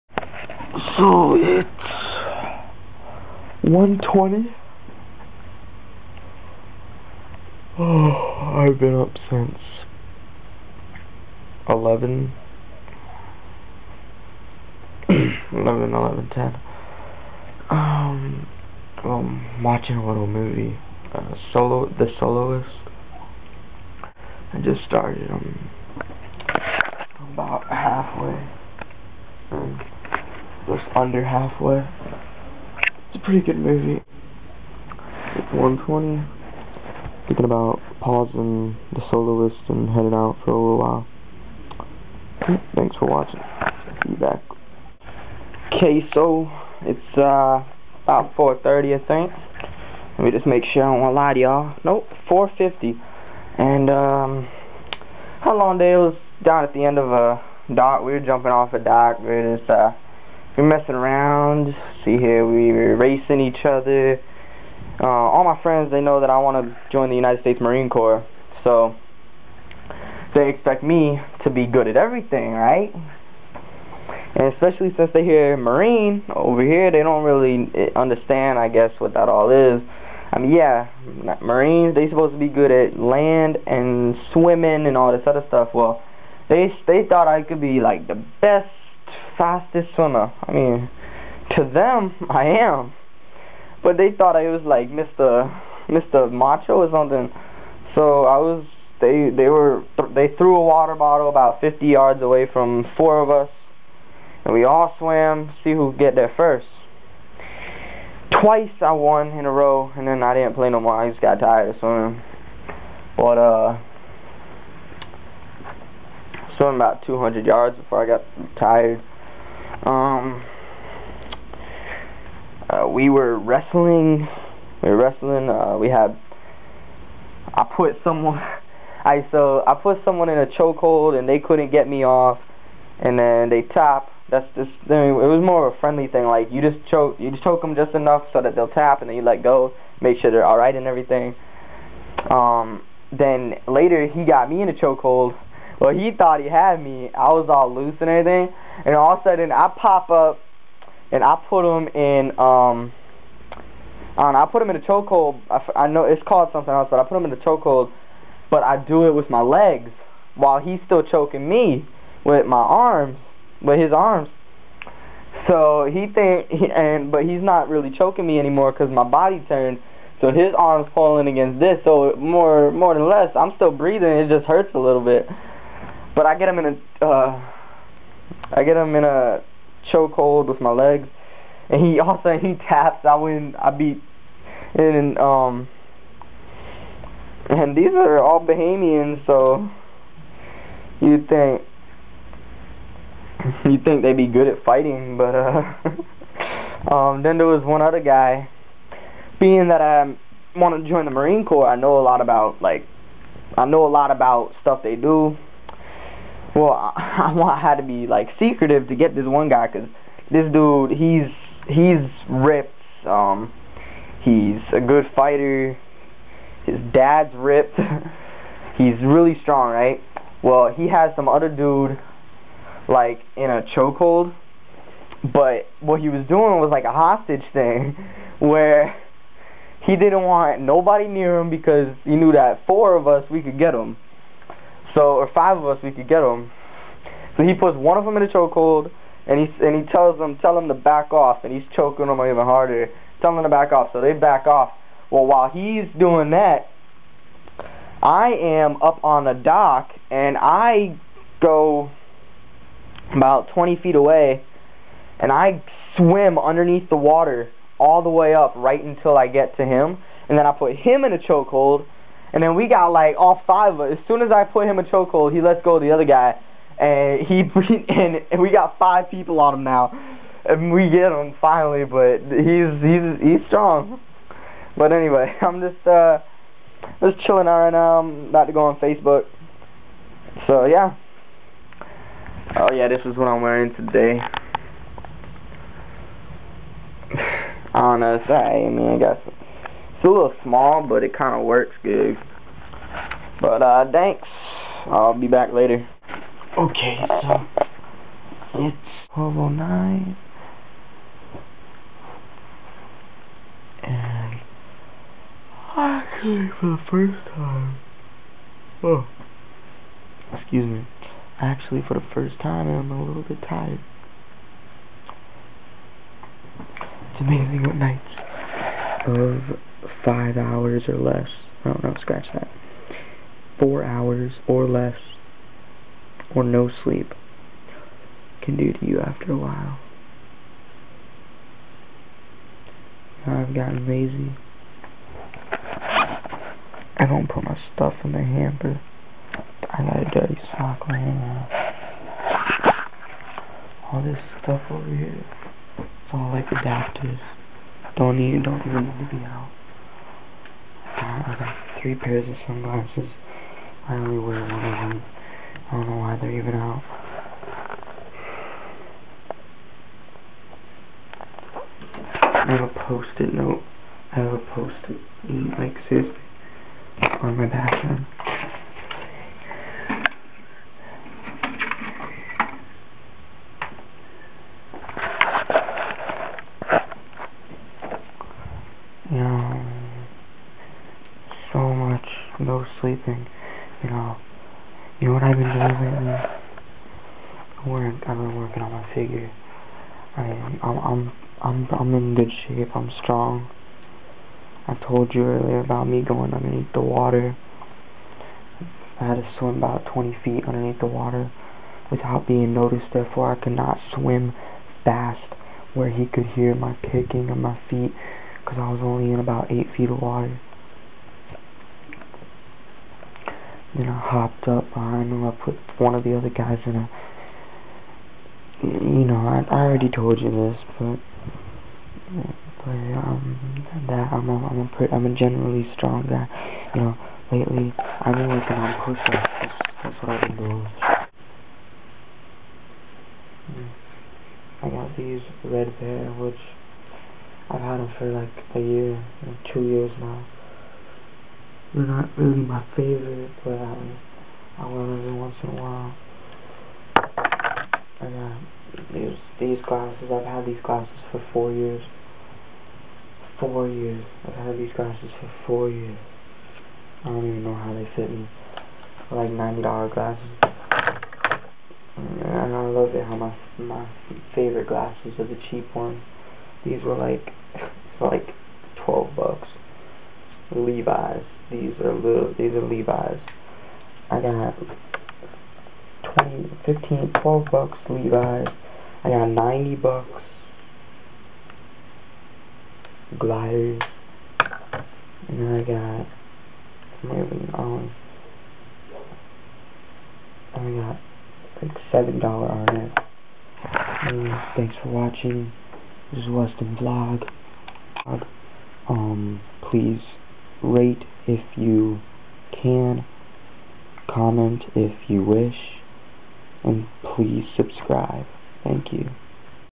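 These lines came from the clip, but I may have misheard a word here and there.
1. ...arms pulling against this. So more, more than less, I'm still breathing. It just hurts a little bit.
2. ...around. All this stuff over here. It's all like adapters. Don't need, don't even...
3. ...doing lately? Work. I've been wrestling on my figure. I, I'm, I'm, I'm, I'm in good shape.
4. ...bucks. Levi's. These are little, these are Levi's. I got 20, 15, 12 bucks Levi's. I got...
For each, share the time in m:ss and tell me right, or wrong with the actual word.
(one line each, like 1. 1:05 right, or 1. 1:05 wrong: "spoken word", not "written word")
1. 2:50 right
2. 5:41 right
3. 6:25 wrong: "working", not "wrestling"
4. 7:49 right.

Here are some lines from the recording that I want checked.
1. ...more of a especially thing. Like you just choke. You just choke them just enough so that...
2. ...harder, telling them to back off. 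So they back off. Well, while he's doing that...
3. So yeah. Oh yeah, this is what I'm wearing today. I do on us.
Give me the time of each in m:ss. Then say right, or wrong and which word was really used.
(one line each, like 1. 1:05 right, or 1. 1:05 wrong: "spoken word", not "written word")
1. 2:15 wrong: "friendly", not "especially"
2. 4:02 right
3. 4:40 right.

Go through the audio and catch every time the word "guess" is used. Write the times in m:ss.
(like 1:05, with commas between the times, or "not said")
1:18, 4:48.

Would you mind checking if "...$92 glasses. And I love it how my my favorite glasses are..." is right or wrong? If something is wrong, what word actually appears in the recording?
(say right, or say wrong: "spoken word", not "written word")
wrong: "90", not "92".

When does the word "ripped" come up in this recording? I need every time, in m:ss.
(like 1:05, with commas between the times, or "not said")
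3:32, 3:37.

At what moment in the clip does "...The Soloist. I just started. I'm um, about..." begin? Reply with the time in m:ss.
0:21.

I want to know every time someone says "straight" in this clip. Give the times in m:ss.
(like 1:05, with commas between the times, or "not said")
not said.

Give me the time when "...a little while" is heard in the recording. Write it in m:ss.
0:40.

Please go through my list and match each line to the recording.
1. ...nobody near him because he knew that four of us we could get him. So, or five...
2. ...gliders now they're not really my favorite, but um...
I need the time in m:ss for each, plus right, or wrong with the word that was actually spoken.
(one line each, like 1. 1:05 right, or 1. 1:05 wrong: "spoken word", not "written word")
1. 3:50 right
2. 7:19 wrong: "years", not "gliders".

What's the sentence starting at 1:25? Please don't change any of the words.
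Well, they they thought I could be like the best fastest swimmer.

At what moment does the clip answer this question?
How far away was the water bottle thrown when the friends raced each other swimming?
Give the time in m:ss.
1:41.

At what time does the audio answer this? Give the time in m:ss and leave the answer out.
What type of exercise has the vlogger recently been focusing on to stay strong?
7:08.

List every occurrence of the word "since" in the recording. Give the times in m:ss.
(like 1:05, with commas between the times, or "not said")
0:09, 1:14.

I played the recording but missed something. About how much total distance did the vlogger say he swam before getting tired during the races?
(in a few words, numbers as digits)
200 yards.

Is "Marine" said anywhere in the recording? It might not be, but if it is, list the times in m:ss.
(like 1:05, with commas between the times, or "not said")
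1:07, 1:15, 1:21, 3:21.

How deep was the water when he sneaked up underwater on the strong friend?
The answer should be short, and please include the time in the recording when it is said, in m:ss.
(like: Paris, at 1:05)
8 feet, at 6:49.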